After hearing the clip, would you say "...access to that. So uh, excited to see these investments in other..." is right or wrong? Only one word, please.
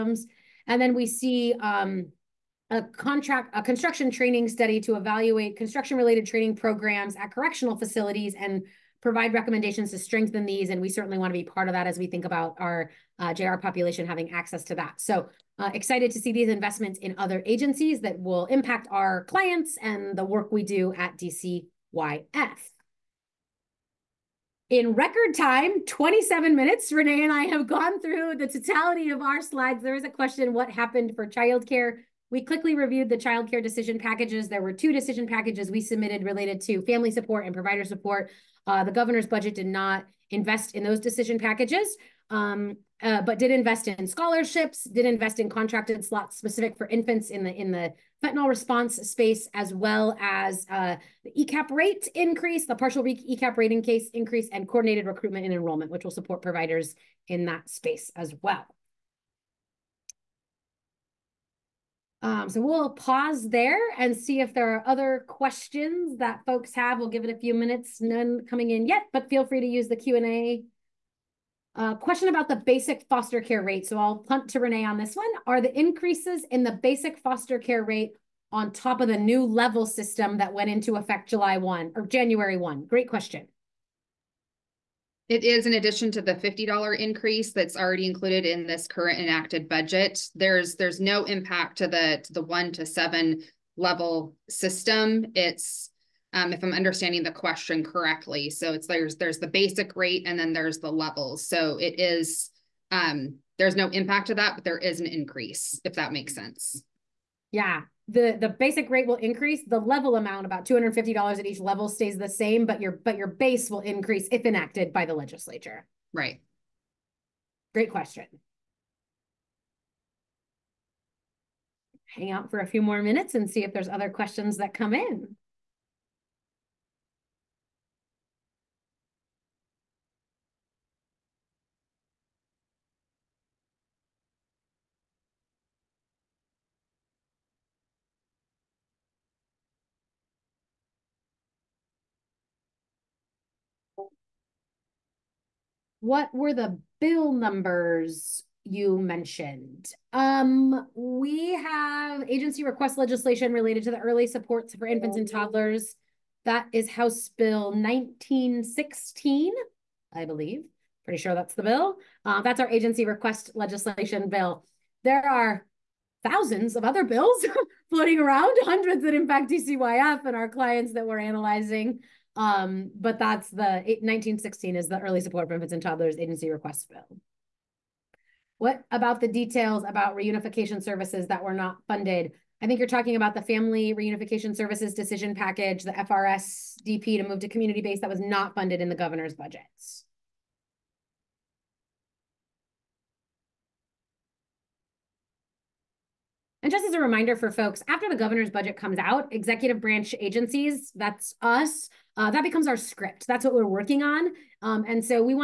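right.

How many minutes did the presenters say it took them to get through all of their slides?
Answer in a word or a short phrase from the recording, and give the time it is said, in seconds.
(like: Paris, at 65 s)
27, at 25 s.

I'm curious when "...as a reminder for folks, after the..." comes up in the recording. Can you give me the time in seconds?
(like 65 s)
196 s.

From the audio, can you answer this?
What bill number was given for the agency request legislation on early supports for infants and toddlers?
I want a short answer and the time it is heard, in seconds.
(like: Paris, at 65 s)
1916, at 156 s.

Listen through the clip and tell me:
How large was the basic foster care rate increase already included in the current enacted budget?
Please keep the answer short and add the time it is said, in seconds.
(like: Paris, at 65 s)
$50, at 86 s.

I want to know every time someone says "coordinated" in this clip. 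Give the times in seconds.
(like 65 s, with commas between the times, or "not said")
54 s.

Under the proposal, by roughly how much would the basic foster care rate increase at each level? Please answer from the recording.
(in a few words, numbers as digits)
$250.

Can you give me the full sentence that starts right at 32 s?
We quickly reviewed the child care decision packages.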